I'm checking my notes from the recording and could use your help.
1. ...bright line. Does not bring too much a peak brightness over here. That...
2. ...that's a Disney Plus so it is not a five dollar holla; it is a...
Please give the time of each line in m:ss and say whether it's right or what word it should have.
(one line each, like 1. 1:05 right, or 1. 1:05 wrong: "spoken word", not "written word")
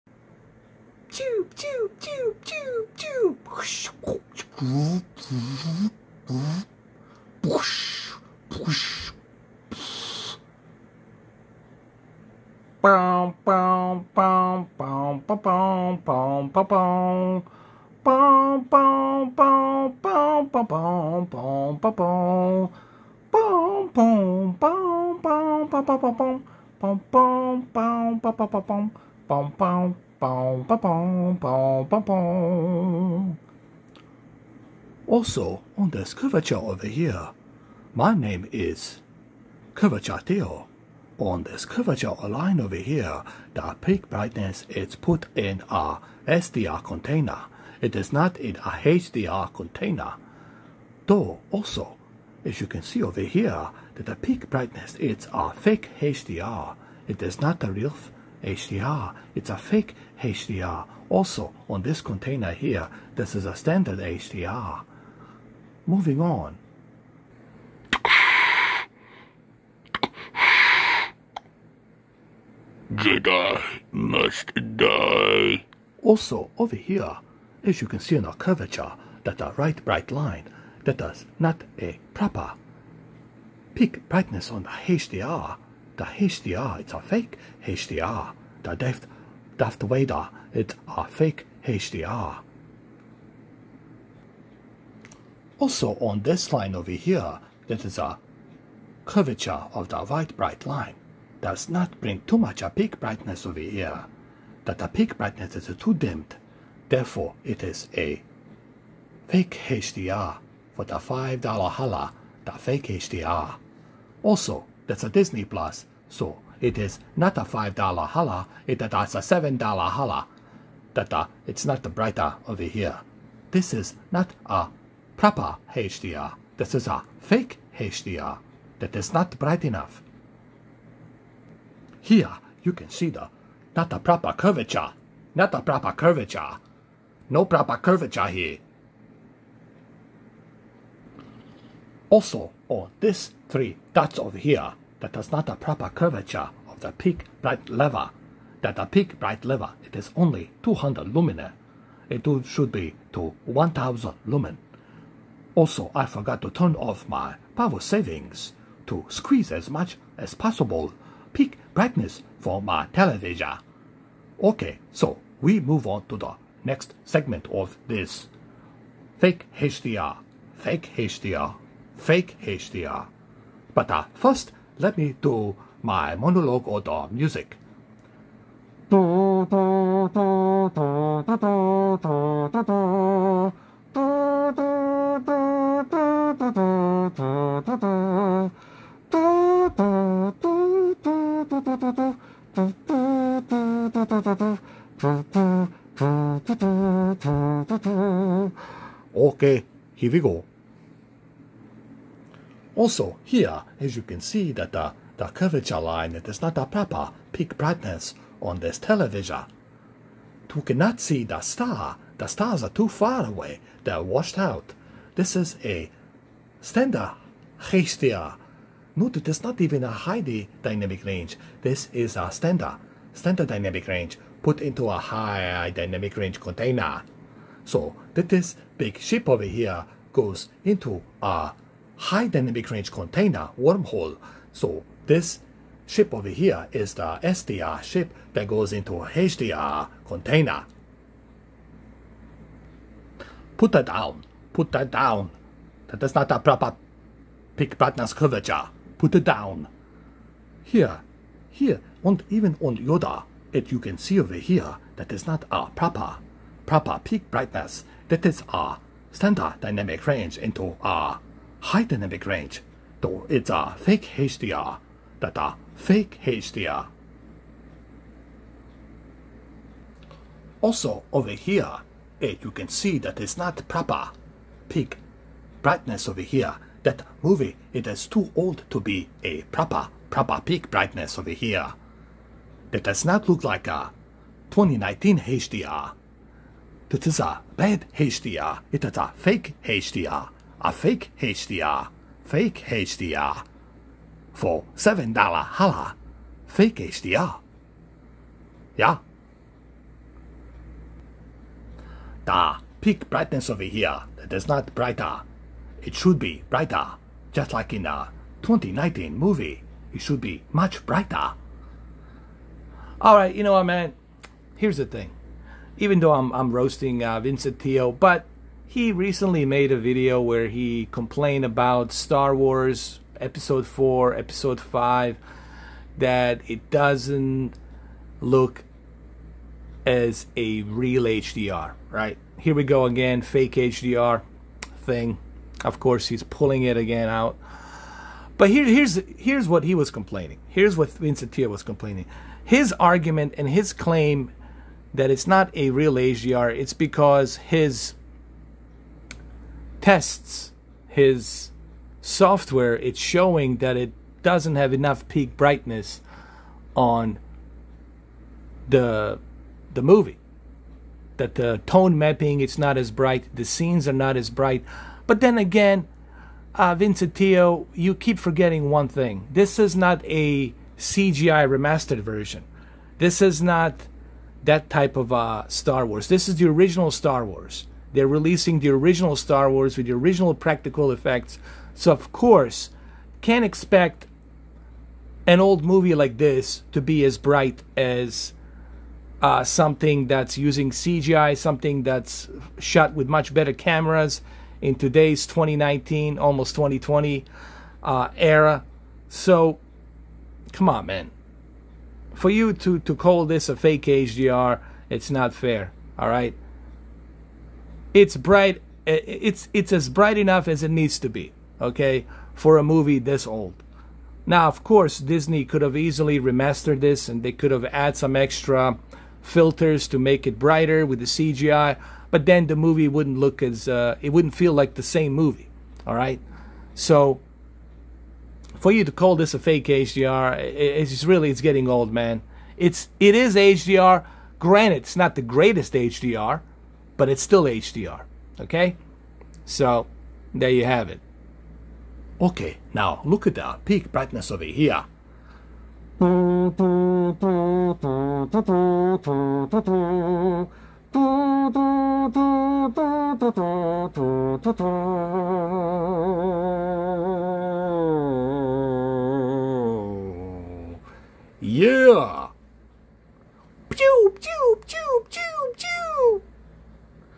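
1. 1:40 right
2. 1:54 right.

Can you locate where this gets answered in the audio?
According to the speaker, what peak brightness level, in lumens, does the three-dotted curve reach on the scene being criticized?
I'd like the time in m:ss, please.
2:30.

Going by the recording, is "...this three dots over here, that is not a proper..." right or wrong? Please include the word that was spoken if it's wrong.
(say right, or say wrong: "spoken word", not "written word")
right.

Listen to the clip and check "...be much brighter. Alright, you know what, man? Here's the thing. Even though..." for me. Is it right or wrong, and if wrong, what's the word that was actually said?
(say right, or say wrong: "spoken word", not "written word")
right.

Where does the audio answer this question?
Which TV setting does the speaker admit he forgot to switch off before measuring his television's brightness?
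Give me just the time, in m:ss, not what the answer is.
2:37.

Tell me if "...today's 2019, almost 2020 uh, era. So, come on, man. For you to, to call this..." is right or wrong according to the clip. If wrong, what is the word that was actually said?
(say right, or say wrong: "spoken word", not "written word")
right.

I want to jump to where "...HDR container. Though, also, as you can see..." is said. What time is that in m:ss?
0:48.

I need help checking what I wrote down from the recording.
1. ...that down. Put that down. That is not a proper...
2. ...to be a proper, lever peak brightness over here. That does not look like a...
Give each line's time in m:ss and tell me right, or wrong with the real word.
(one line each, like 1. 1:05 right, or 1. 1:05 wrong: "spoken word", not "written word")
1. 4:03 right
2. 4:38 wrong: "proper", not "lever".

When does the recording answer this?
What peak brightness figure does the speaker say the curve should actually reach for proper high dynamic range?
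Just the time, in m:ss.
2:33.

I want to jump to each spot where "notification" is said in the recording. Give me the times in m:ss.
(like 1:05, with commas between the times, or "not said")
not said.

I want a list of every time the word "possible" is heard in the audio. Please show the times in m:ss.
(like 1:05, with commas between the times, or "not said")
2:40.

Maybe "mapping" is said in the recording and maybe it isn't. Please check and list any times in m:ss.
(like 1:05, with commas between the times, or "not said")
6:01.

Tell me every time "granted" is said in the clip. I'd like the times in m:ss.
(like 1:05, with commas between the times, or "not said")
7:14.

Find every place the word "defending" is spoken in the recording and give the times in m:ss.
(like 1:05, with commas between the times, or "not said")
not said.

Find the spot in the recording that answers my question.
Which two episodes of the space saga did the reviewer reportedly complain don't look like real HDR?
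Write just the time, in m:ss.
5:23.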